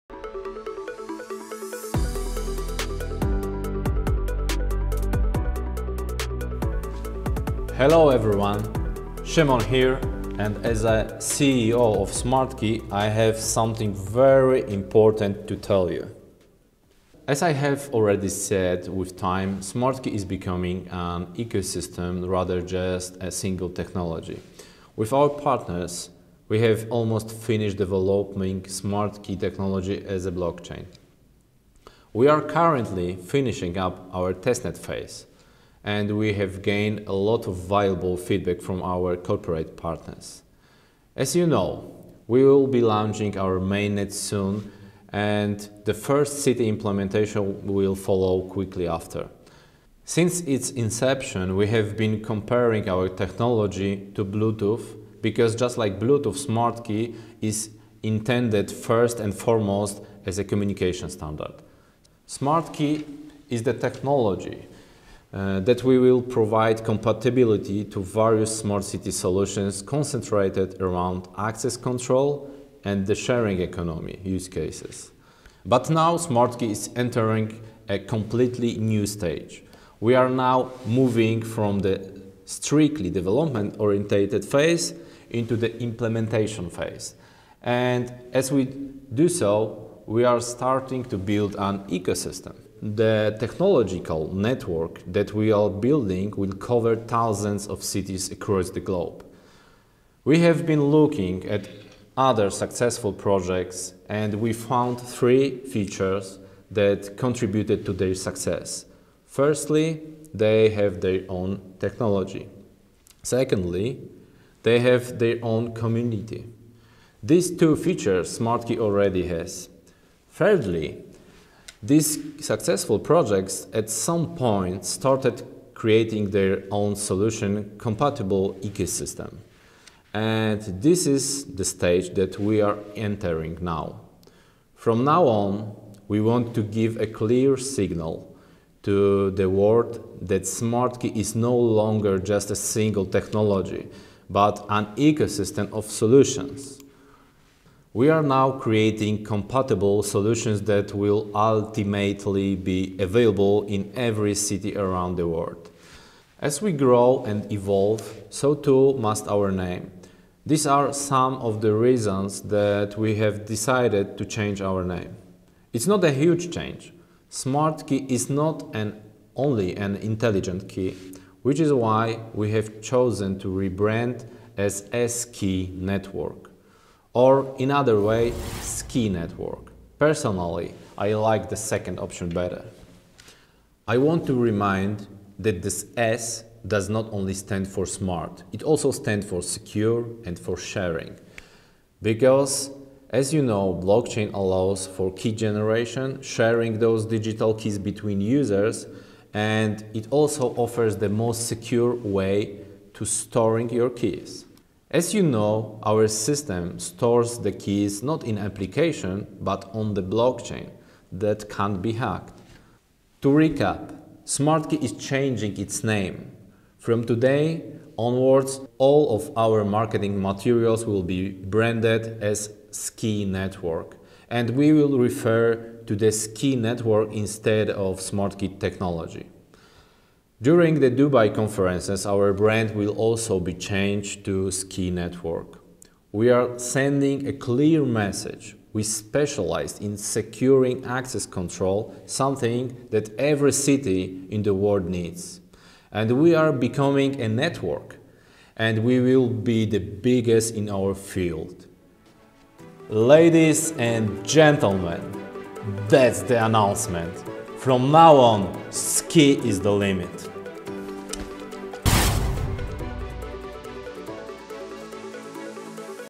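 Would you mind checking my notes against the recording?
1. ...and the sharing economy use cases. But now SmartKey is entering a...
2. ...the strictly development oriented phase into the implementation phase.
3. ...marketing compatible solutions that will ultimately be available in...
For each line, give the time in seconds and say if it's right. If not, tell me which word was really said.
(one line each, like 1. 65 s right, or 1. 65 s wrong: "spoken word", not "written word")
1. 72 s right
2. 81 s right
3. 148 s wrong: "creating", not "marketing".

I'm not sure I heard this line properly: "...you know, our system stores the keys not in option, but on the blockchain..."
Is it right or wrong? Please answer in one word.
wrong.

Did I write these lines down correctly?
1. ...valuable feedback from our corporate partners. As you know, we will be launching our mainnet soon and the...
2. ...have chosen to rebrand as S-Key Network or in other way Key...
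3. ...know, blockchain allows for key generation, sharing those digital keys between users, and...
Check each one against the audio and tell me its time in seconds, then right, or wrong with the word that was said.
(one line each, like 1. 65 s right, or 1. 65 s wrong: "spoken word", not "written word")
1. 37 s right
2. 172 s wrong: "Skey", not "Key"
3. 193 s right.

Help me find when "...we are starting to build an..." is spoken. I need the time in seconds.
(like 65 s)
90 s.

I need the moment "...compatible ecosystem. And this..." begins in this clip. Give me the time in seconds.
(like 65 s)
127 s.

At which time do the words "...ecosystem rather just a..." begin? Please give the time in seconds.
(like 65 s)
21 s.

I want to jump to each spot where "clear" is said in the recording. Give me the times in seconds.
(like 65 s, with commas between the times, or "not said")
137 s, 237 s.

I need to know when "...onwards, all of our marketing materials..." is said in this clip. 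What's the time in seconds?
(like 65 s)
217 s.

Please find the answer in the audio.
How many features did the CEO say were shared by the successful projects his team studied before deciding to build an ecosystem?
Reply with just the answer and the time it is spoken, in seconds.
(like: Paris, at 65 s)
3, at 104 s.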